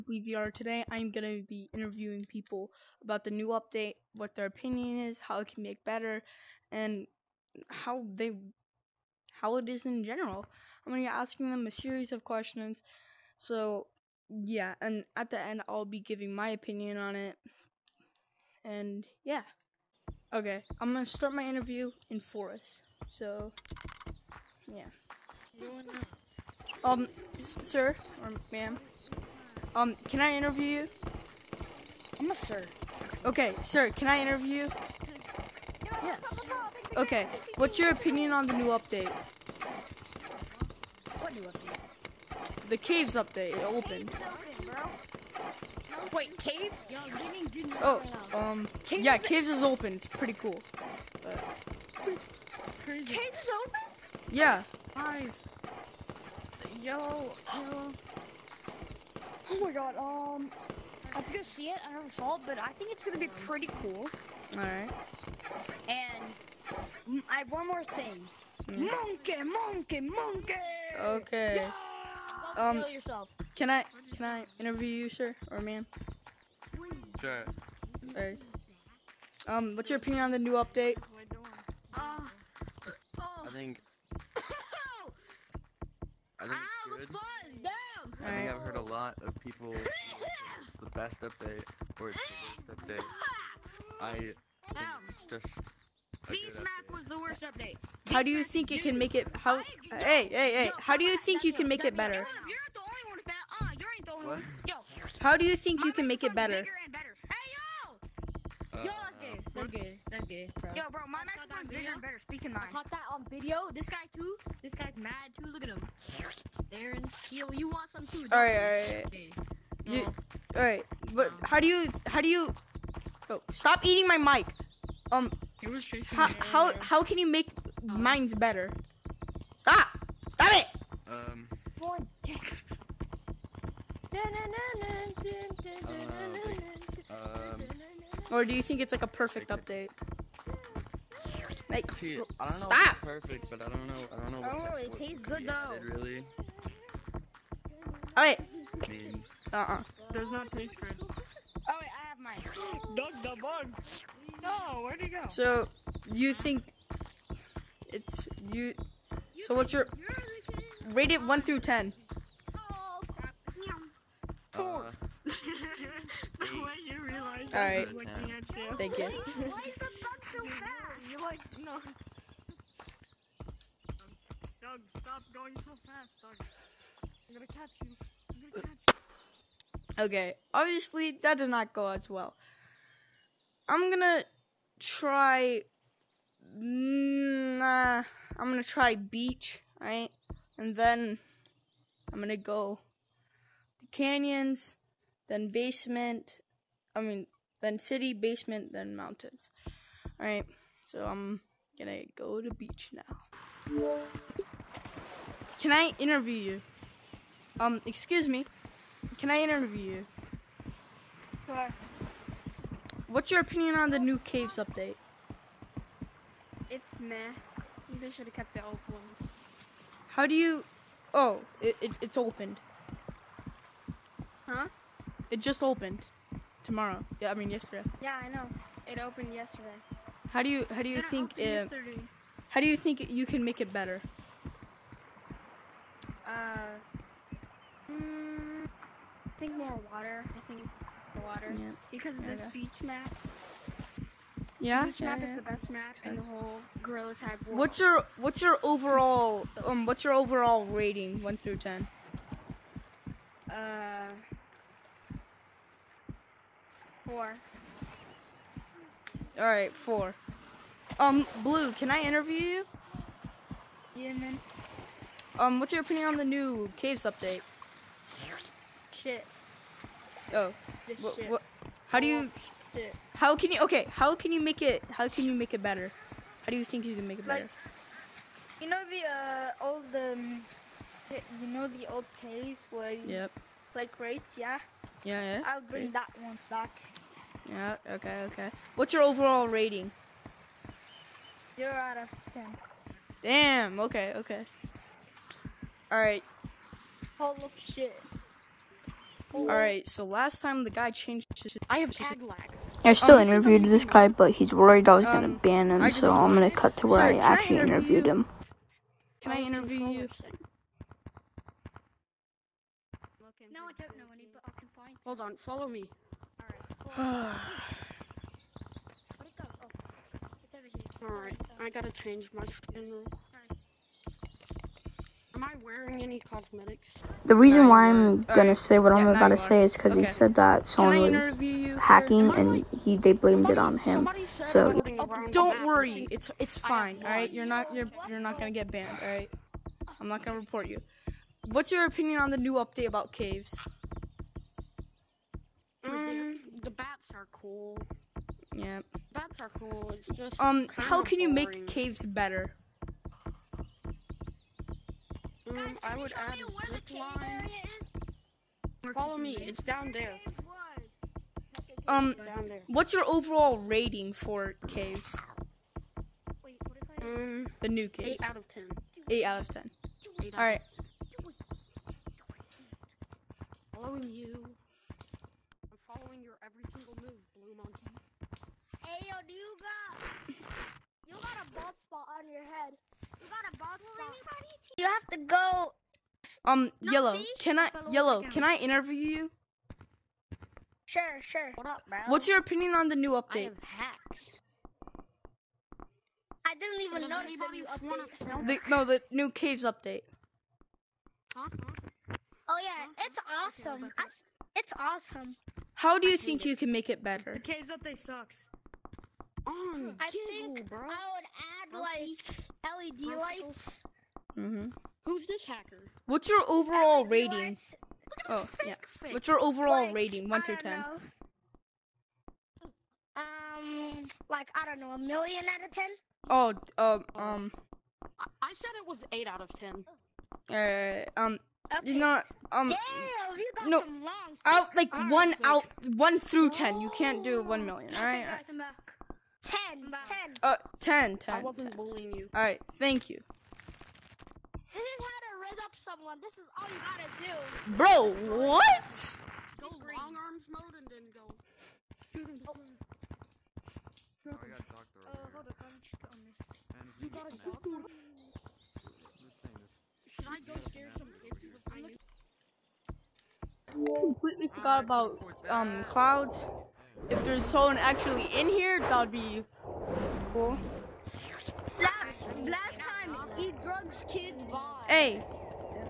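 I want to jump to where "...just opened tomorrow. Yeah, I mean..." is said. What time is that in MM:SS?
03:45.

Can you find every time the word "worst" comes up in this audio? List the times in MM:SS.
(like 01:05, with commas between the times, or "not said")
01:32, 01:37.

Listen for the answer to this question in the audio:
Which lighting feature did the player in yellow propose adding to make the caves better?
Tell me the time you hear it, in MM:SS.
06:52.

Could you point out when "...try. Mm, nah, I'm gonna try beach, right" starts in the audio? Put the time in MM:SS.
03:04.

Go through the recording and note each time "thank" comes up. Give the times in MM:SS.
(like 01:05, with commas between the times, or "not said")
02:48, 07:22.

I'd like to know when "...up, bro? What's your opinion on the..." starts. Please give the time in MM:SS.
06:31.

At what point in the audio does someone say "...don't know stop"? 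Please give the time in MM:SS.
02:22.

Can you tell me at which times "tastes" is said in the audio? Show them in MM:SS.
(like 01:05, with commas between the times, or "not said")
02:24, 02:30.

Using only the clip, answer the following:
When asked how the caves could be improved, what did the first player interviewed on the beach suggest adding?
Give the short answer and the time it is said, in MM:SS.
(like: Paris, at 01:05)
More water, at 03:59.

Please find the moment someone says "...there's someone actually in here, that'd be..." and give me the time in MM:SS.
07:47.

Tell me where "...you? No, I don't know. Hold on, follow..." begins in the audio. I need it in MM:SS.
05:09.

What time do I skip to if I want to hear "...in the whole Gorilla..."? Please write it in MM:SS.
04:06.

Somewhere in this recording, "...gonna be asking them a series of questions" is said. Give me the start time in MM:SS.
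00:10.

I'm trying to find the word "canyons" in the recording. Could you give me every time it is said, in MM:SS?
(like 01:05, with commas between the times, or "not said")
03:13.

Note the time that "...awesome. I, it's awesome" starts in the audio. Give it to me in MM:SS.
06:43.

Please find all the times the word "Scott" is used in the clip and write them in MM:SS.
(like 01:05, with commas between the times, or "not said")
not said.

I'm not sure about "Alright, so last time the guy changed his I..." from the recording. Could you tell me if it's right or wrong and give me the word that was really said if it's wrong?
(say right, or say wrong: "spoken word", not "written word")
right.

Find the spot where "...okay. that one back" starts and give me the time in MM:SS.
04:45.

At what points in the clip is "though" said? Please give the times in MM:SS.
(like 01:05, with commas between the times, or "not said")
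02:25.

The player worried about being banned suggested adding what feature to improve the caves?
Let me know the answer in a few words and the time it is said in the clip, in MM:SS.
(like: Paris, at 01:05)
Zip line, at 05:56.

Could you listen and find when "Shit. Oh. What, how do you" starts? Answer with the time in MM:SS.
04:28.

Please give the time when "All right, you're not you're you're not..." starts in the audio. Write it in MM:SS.
05:37.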